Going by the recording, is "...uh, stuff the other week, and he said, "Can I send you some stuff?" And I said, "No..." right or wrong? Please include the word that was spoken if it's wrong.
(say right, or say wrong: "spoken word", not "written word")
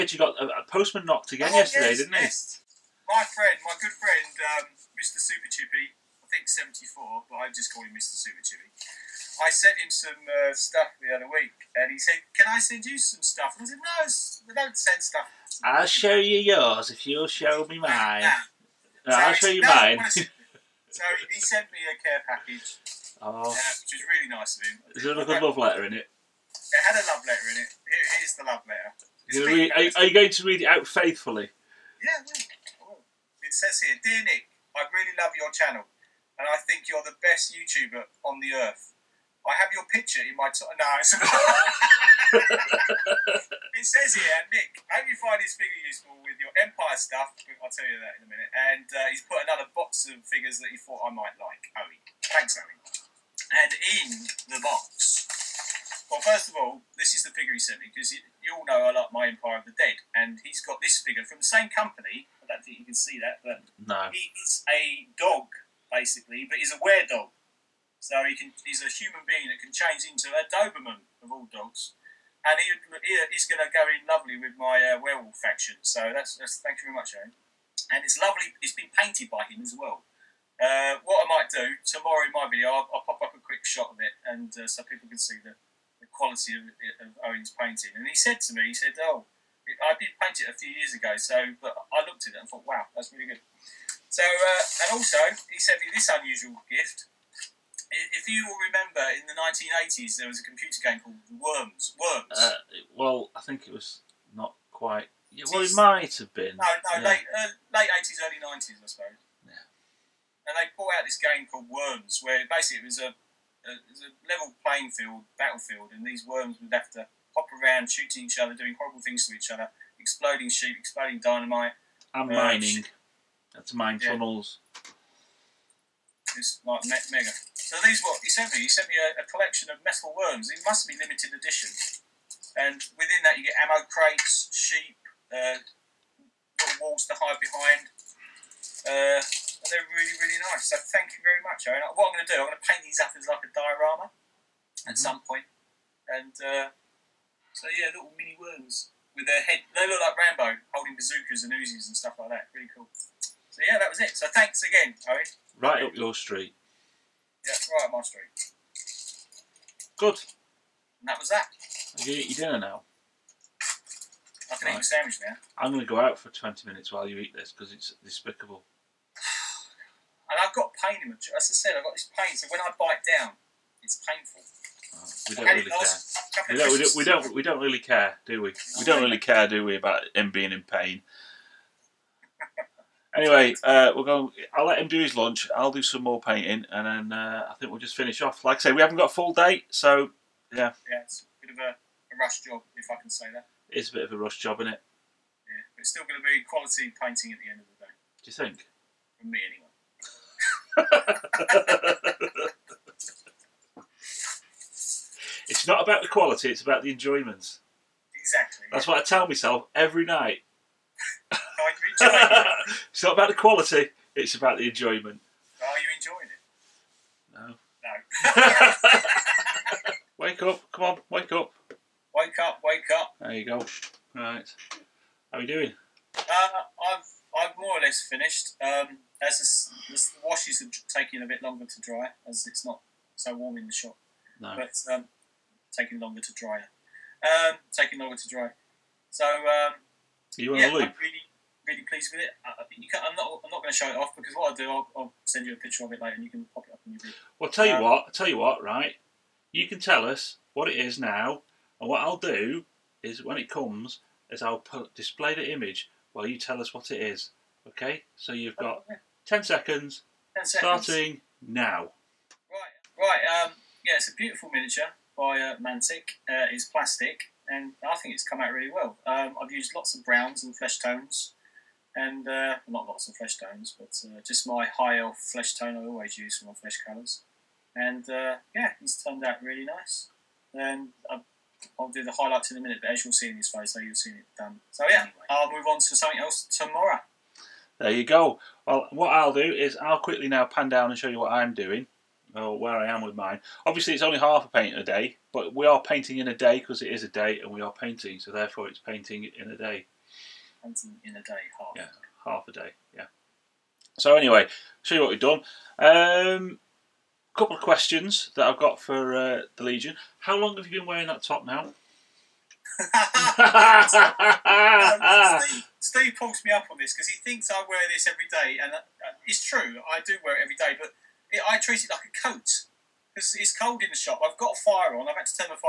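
right.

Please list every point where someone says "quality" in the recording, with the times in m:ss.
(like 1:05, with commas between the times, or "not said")
1:26, 3:16, 3:26, 3:33.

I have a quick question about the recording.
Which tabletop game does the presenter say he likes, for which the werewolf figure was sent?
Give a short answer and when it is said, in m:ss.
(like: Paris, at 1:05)
Empire of the Dead, at 0:59.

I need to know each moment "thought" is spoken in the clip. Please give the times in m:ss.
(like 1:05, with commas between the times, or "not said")
0:50, 1:32.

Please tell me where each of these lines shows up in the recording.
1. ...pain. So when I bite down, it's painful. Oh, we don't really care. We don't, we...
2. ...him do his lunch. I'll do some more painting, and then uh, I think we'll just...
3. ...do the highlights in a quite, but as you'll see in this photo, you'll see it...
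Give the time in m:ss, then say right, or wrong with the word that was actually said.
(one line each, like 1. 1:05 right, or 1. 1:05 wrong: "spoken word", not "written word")
1. 2:52 right
2. 3:04 right
3. 4:41 wrong: "minute", not "quite".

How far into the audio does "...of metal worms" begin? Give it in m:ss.
2:09.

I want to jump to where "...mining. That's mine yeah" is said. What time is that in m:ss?
2:02.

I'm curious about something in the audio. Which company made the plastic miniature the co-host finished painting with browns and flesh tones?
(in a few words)
Mantic.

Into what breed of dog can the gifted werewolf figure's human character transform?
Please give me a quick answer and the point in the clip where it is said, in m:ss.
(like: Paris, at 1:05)
Doberman, at 1:10.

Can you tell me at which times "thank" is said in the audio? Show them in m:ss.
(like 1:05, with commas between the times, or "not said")
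0:52, 1:16, 2:20, 2:34.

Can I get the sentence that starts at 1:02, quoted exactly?
I don't think you can see that, but no.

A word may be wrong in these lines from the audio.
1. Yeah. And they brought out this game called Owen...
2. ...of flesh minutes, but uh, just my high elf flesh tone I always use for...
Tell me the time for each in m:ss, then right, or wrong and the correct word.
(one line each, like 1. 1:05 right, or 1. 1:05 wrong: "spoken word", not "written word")
1. 1:49 wrong: "Worms", not "Owen"
2. 4:33 wrong: "tones", not "minutes".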